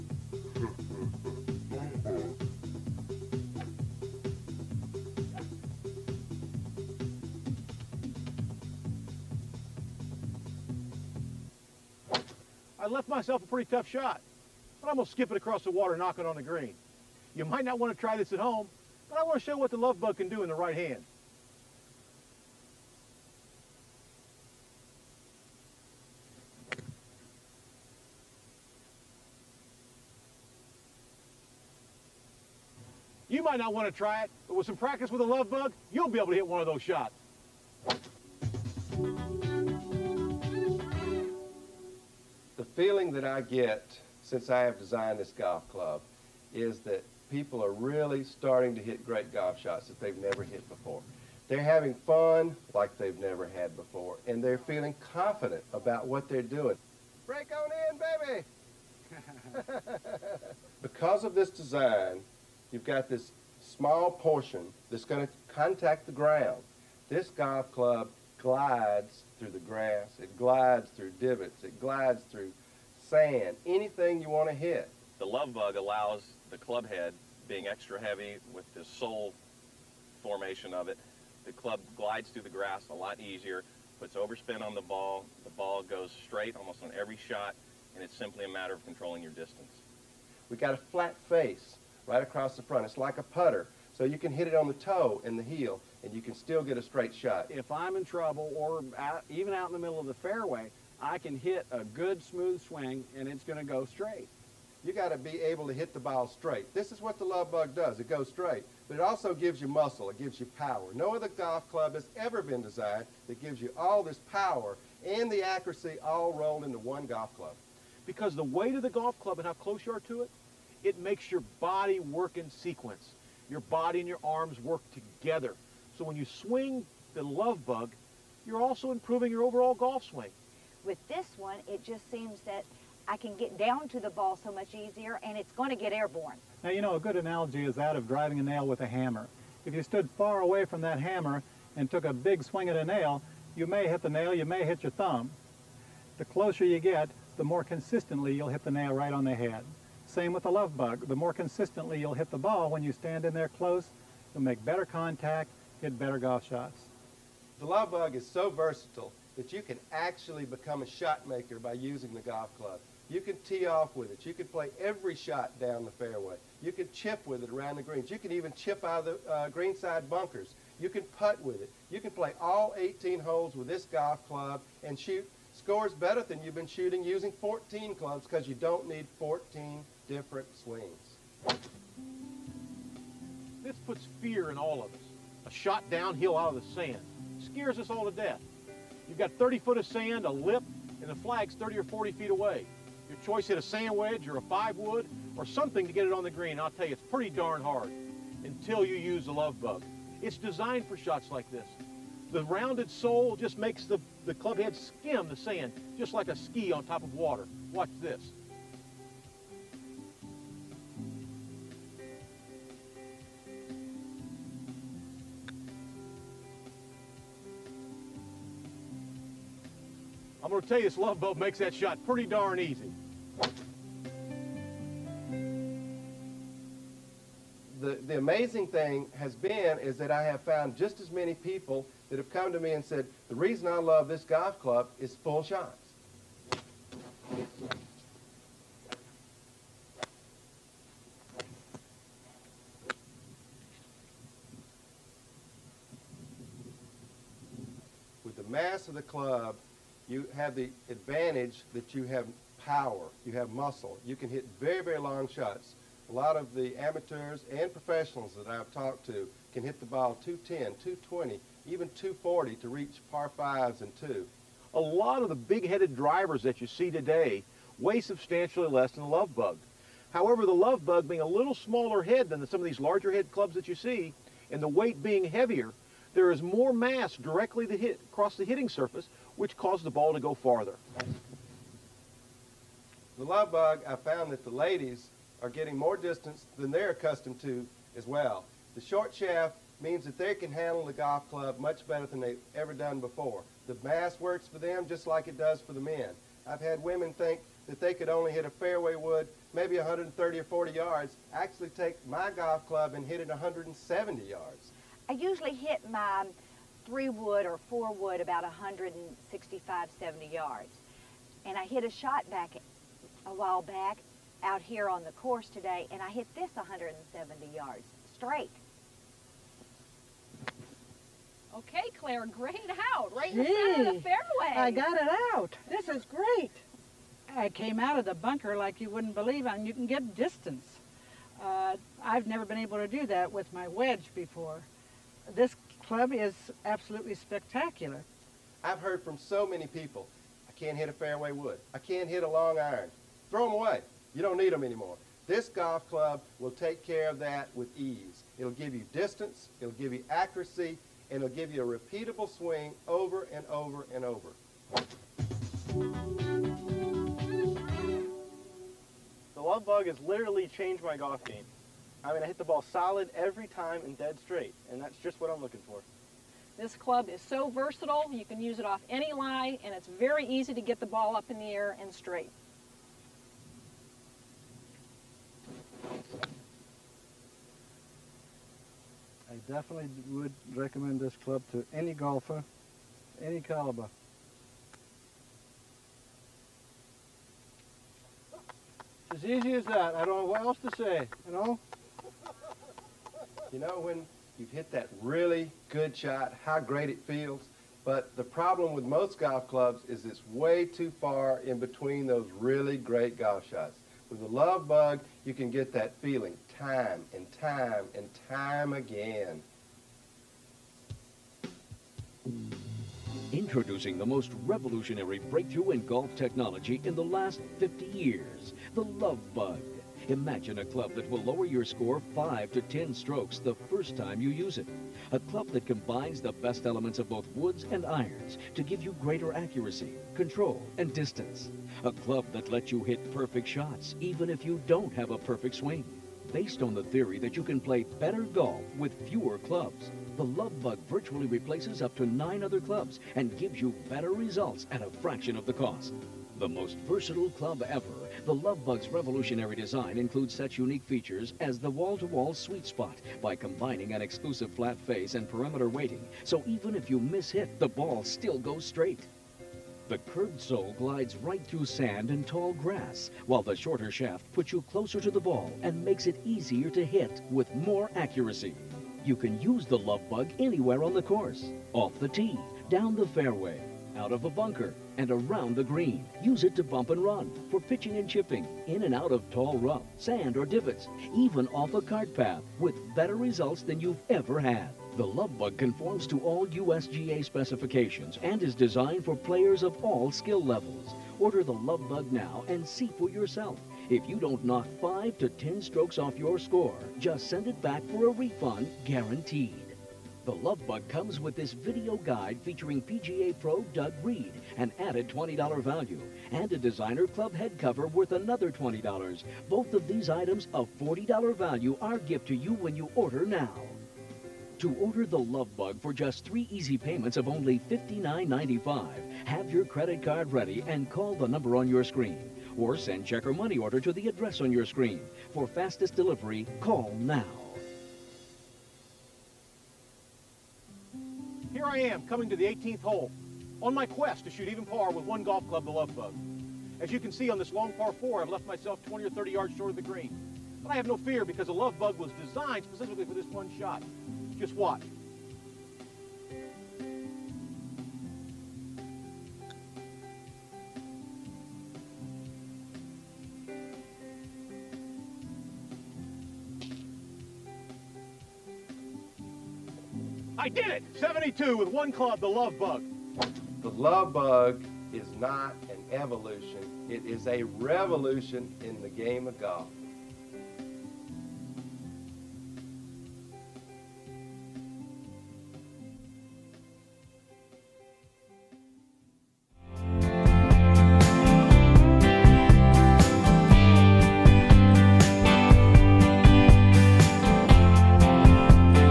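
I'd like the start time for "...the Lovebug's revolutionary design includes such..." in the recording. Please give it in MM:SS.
07:28.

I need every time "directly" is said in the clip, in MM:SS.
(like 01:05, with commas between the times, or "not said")
04:37.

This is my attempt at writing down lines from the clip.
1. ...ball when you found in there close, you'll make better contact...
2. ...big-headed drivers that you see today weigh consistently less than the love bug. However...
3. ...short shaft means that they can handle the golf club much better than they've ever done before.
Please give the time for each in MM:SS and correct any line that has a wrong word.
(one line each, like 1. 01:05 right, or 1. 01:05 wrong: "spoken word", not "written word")
1. 02:32 wrong: "stand", not "found"
2. 04:25 wrong: "substantially", not "consistently"
3. 04:48 right.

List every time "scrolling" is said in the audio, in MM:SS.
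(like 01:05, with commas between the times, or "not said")
not said.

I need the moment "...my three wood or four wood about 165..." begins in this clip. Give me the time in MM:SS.
05:05.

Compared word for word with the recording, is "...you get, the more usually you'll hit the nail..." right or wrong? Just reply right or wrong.
wrong.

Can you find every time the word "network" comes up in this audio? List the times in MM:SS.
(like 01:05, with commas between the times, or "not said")
not said.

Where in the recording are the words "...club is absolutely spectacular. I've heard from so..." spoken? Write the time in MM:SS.
05:35.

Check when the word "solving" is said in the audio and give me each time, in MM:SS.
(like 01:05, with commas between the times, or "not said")
not said.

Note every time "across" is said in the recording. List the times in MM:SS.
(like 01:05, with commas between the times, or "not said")
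00:15, 01:32, 04:38.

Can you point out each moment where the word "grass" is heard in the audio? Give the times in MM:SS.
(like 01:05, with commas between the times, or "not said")
01:09, 01:22, 07:42.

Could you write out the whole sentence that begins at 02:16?
Now, you know, a good analogy is that of driving a nail with a hammer.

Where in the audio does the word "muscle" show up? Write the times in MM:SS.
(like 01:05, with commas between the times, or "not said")
01:49, 04:13.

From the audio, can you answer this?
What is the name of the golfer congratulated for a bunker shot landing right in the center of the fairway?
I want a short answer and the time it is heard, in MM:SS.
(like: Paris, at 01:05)
Claire, at 05:21.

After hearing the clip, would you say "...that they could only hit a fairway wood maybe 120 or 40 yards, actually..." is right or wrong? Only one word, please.
wrong.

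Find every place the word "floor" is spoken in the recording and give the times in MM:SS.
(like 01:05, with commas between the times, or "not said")
not said.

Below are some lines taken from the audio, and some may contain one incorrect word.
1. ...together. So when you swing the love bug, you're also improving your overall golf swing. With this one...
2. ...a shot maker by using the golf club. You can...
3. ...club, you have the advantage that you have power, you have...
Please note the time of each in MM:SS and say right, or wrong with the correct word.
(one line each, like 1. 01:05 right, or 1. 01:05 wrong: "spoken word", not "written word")
1. 02:05 right
2. 02:40 right
3. 04:09 right.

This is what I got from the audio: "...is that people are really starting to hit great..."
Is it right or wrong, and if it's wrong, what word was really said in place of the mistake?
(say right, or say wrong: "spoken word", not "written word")
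right.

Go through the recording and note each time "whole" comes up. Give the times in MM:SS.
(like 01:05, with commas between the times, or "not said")
not said.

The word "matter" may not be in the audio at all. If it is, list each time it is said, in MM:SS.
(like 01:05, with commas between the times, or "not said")
01:28.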